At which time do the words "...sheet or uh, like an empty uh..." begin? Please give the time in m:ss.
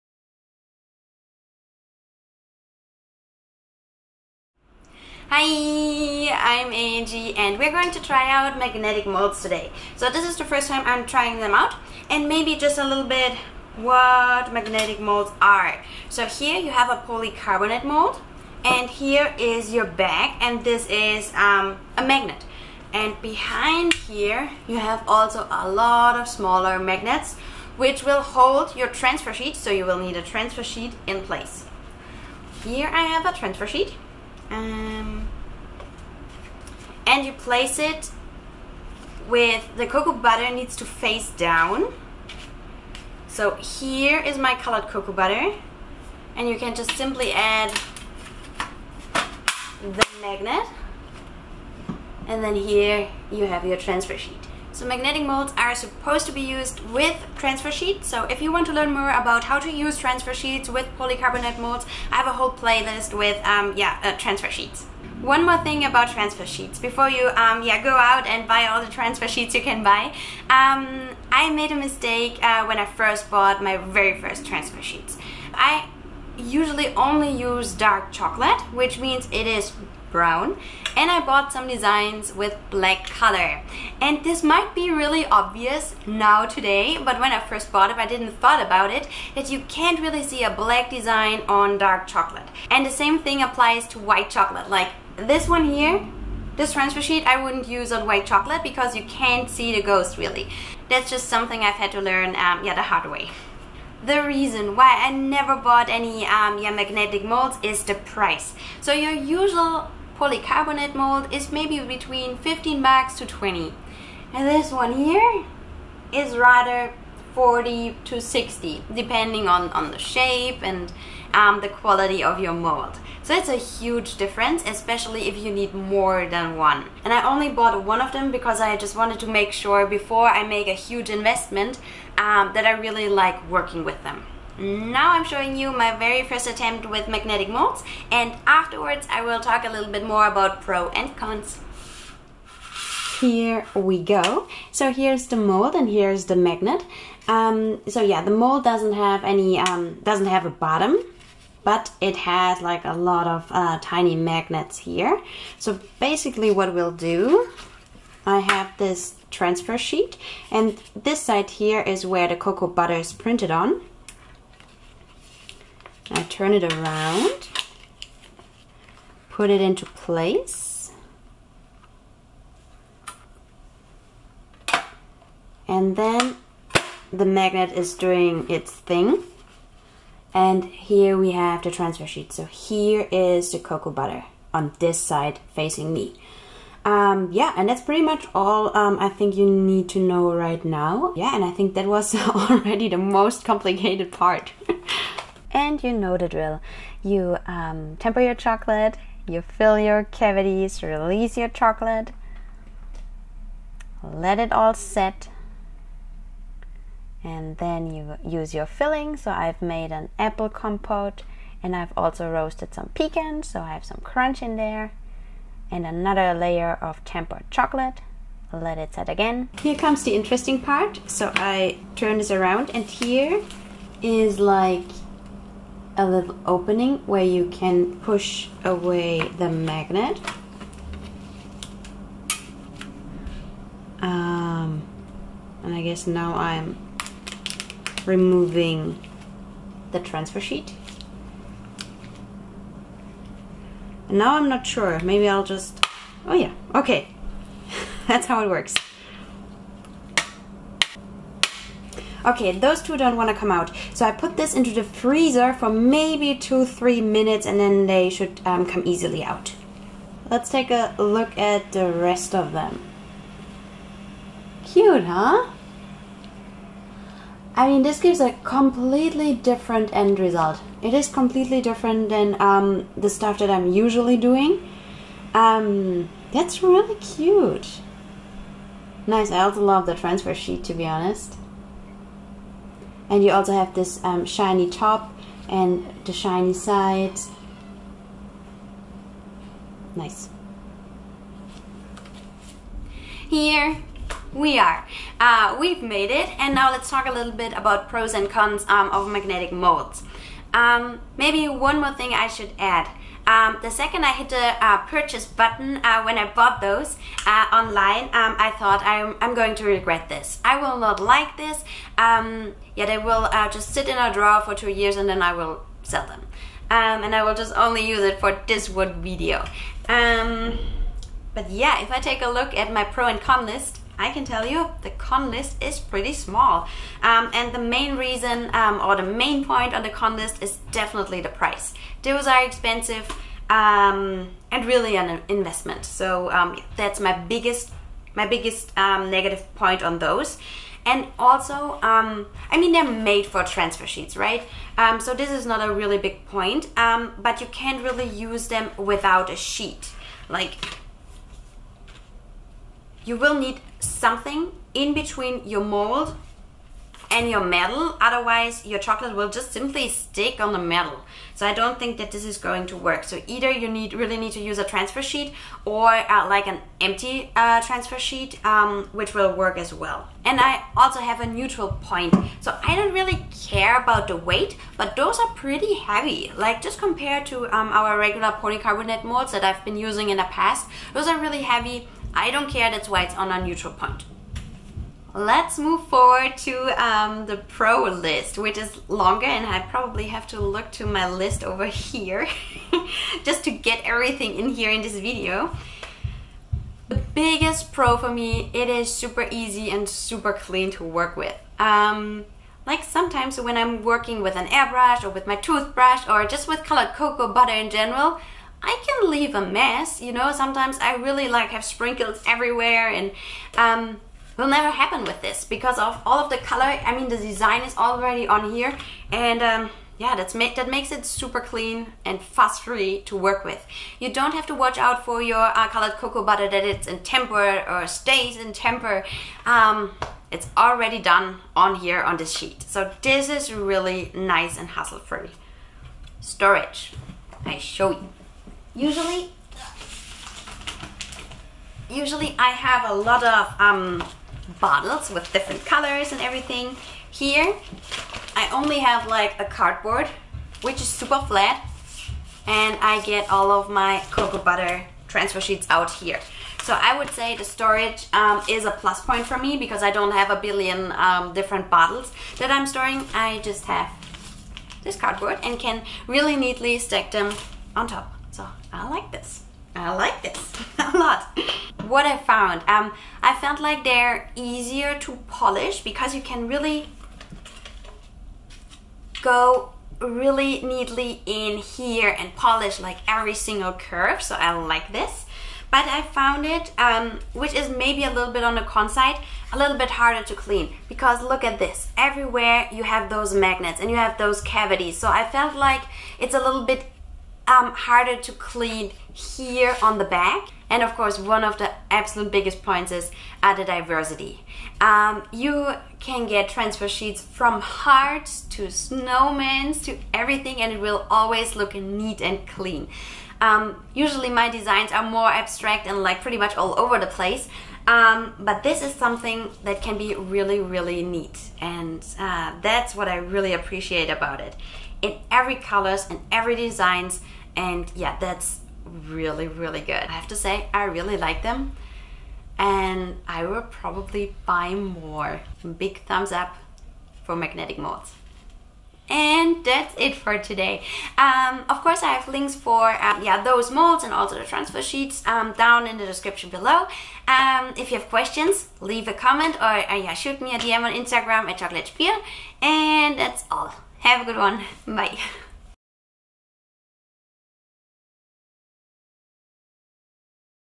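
6:05.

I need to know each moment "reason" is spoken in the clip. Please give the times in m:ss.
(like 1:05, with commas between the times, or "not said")
1:44, 5:27.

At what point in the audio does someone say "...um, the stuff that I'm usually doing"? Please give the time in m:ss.
4:32.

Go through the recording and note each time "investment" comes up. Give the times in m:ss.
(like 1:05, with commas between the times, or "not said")
2:11, 5:35.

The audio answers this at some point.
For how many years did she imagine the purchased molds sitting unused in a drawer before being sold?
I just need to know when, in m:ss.
5:14.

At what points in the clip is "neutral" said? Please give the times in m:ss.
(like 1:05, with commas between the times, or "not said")
6:11, 6:23.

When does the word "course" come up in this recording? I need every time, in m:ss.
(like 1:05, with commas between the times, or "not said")
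8:20, 9:01.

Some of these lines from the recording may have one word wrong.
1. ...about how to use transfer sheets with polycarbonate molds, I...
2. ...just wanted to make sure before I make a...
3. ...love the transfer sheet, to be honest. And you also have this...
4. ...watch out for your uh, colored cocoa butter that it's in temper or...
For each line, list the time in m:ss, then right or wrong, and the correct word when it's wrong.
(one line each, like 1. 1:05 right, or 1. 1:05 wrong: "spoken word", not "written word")
1. 0:59 right
2. 2:08 right
3. 4:39 right
4. 7:04 right.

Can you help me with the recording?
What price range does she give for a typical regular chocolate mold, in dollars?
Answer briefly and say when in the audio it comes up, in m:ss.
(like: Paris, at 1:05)
15 to 20, at 1:52.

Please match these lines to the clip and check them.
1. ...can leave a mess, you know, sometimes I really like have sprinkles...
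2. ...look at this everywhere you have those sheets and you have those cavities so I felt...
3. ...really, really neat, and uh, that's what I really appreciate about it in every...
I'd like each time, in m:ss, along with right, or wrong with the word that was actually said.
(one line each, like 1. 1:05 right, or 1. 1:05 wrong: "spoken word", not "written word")
1. 6:48 right
2. 8:11 wrong: "magnets", not "sheets"
3. 8:40 right.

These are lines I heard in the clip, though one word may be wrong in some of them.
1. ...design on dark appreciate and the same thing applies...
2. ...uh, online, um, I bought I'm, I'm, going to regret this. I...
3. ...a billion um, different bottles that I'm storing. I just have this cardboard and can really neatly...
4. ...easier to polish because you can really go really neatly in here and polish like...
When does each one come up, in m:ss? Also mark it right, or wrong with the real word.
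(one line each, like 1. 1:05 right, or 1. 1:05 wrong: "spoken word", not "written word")
1. 1:30 wrong: "chocolate", not "appreciate"
2. 5:07 wrong: "thought", not "bought"
3. 7:40 right
4. 7:54 right.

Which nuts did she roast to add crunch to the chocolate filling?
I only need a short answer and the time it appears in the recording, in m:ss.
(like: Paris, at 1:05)
pecans, at 3:32.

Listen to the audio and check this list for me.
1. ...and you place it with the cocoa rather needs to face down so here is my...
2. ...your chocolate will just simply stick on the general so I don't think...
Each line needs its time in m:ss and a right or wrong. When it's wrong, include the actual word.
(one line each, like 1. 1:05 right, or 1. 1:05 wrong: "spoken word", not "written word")
1. 0:37 wrong: "butter", not "rather"
2. 5:58 wrong: "metal", not "general".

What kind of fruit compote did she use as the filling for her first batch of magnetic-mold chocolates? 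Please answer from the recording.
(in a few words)
apple.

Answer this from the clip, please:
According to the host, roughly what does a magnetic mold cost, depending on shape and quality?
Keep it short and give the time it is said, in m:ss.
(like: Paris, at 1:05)
40 to 60, at 1:57.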